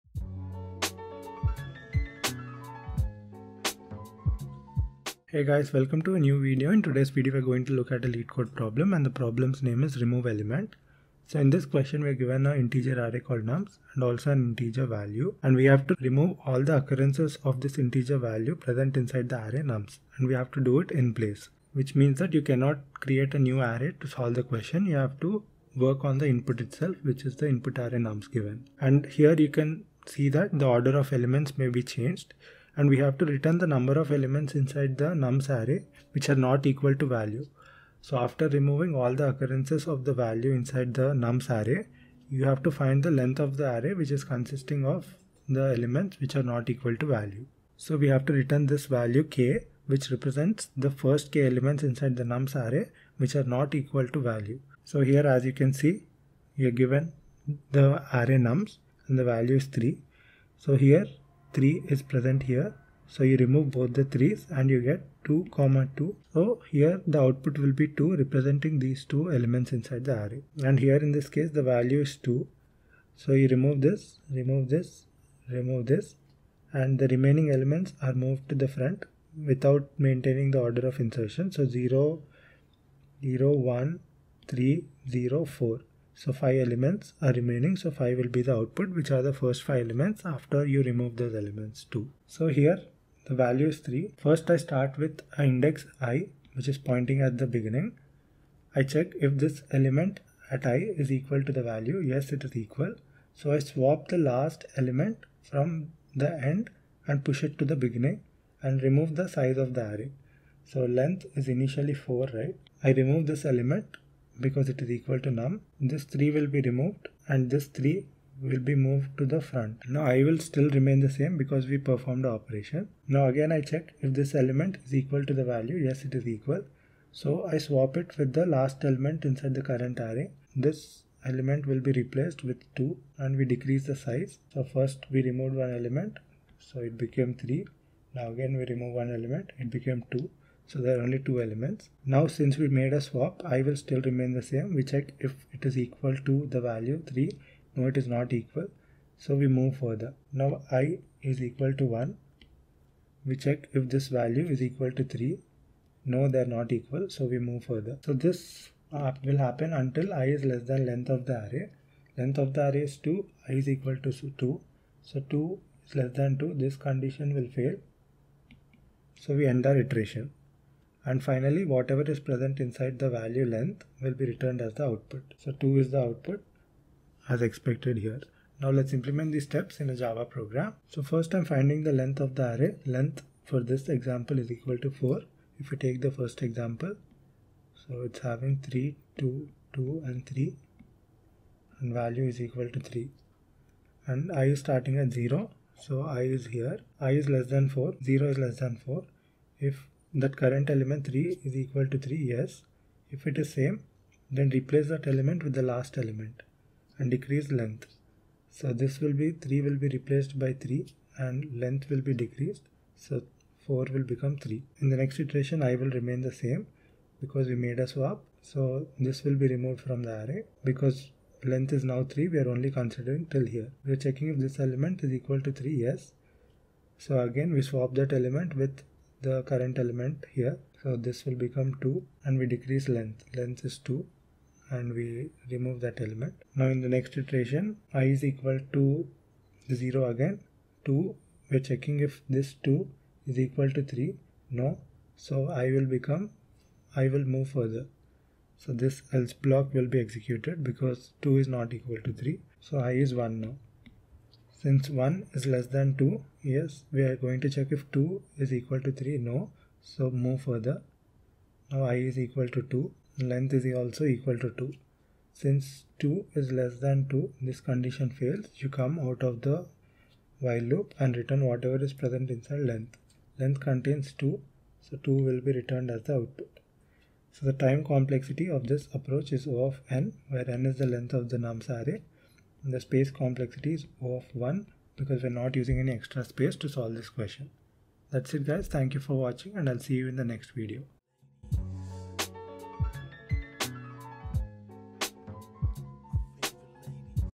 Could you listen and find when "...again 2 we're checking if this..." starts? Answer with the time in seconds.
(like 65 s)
240 s.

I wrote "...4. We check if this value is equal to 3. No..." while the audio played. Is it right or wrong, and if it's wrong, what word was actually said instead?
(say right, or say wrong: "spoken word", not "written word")
wrong: "1", not "4".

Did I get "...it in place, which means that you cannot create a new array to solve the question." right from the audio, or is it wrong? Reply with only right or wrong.
right.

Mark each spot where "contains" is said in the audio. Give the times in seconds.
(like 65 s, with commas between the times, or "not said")
273 s.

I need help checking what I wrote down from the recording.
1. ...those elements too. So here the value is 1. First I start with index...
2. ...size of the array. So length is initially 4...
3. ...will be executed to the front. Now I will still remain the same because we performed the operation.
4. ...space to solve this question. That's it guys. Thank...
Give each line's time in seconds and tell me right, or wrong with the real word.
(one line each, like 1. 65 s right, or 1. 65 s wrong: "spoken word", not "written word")
1. 91 s wrong: "3", not "1"
2. 109 s right
3. 118 s wrong: "moved", not "executed"
4. 286 s right.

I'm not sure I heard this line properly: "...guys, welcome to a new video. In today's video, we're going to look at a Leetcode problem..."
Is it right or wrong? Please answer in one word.
right.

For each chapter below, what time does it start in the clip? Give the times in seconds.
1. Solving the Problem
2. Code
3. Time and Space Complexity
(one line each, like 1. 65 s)
1. 92 s
2. 180 s
3. 277 s.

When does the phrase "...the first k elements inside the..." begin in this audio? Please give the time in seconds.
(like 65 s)
50 s.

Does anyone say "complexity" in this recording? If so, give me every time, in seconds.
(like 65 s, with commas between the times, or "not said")
277 s, 283 s.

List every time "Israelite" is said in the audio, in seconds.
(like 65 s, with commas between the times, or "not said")
not said.